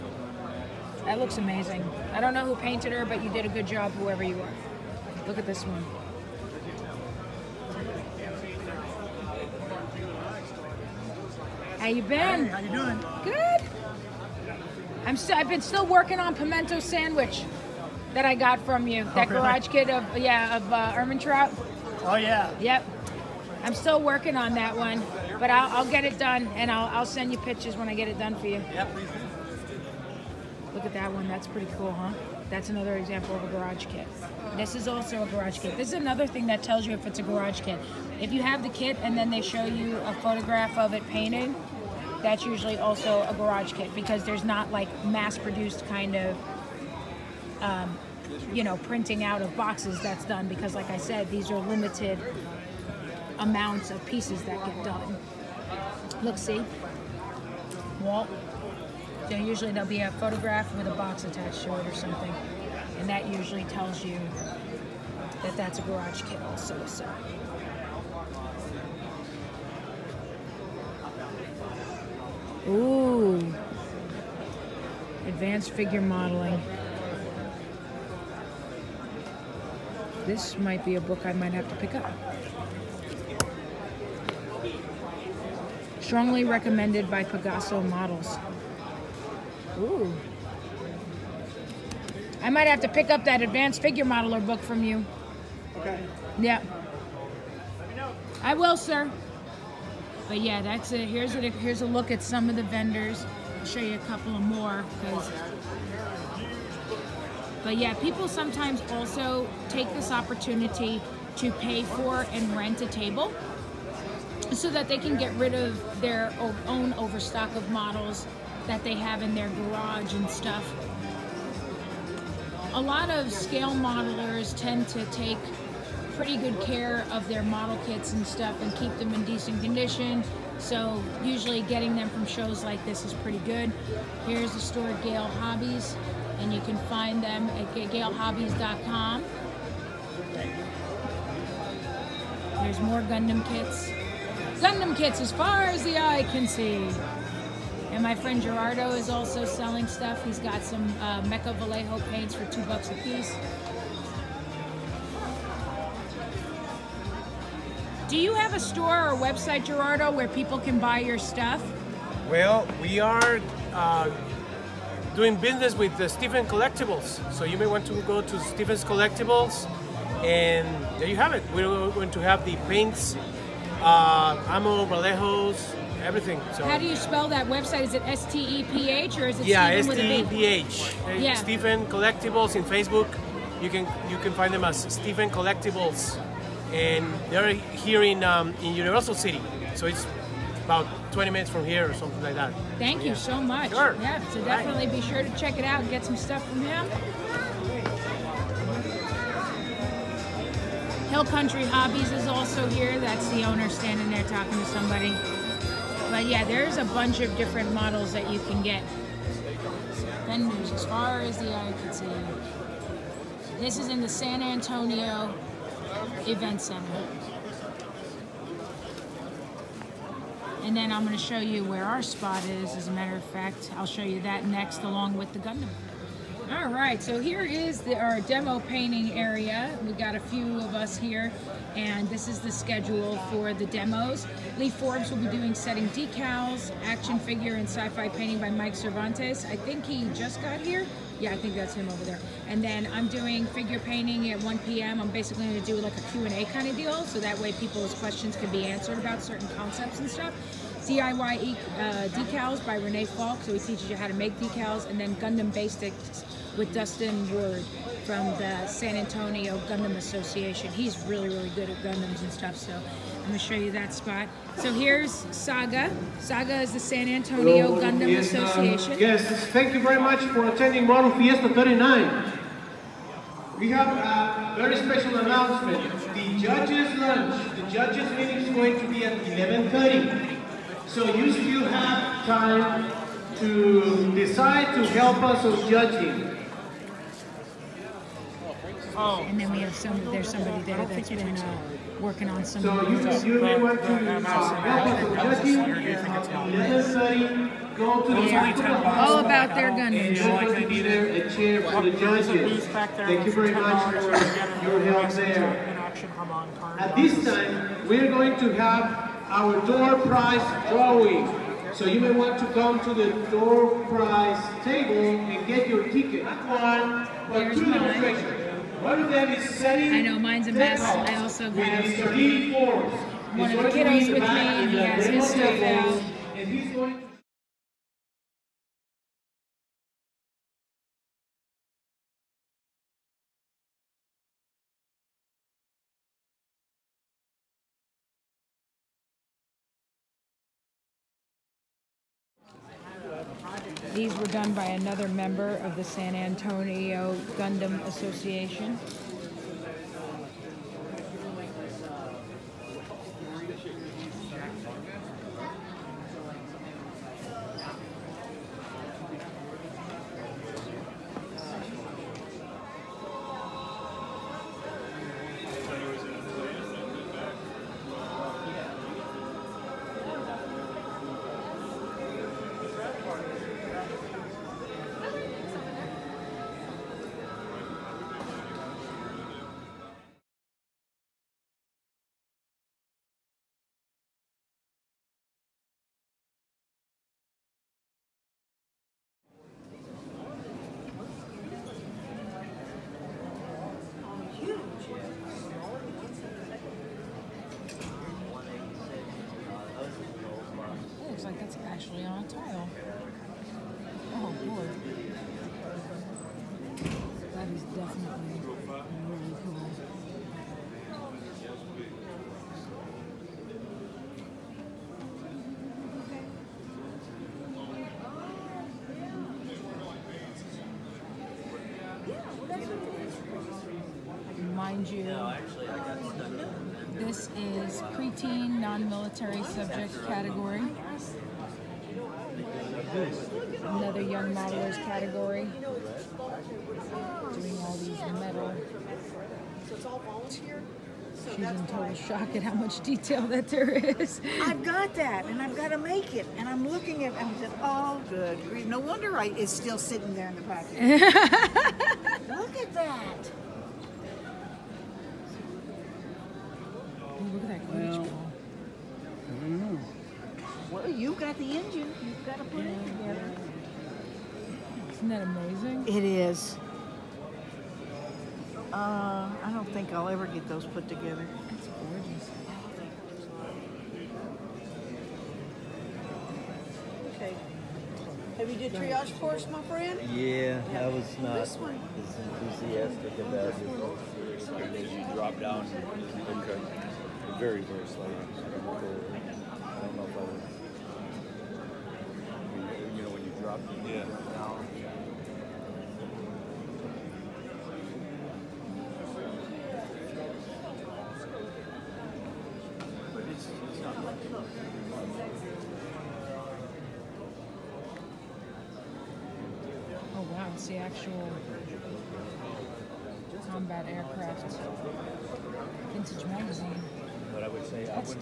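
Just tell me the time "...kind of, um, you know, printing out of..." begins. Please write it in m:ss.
0:45.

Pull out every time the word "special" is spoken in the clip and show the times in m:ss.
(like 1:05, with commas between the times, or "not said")
4:34.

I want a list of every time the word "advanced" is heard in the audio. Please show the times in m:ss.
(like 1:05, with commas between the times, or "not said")
1:15, 1:33.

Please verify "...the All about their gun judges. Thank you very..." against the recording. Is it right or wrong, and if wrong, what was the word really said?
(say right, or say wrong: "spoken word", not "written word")
right.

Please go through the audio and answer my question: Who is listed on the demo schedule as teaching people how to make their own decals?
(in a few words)
Renee Falk.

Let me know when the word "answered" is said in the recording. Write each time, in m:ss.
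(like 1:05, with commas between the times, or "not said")
4:08.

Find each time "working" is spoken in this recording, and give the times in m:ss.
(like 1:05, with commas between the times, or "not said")
0:15, 0:24, 4:52.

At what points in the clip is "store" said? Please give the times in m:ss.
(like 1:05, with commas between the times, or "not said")
2:14, 2:38.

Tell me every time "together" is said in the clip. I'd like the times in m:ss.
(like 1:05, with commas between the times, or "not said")
7:42, 7:50.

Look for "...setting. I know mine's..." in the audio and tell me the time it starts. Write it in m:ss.
5:19.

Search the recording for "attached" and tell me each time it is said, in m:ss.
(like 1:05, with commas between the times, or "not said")
1:01.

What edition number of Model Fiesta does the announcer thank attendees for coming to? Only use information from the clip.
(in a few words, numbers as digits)
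39.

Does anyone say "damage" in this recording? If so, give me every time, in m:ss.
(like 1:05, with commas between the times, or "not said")
not said.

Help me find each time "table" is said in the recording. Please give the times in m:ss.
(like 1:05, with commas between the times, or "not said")
1:52, 5:14.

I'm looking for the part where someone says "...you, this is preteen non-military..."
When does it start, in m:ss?
7:04.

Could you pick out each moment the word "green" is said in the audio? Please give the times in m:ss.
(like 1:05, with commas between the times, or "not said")
not said.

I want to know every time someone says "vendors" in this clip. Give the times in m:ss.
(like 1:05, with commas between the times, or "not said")
1:42, 3:30.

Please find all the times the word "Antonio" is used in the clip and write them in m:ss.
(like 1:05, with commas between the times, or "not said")
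3:34, 4:18, 4:27, 5:46.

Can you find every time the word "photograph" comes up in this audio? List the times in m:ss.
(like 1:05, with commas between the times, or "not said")
0:40, 1:00.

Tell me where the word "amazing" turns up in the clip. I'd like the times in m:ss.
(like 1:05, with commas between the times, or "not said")
0:01, 7:45.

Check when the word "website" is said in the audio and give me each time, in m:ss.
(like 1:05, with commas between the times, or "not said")
2:39, 2:57.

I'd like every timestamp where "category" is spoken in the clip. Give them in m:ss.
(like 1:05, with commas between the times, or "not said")
7:10, 7:14.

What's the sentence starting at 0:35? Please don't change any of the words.
This is another thing that tells you if it's a garage kit.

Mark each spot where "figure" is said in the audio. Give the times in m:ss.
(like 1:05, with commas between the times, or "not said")
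1:15, 1:33, 3:57, 4:03.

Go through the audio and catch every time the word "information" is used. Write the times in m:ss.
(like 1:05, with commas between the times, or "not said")
not said.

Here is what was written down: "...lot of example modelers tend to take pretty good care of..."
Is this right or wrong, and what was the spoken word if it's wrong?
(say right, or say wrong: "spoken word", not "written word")
wrong: "scale", not "example".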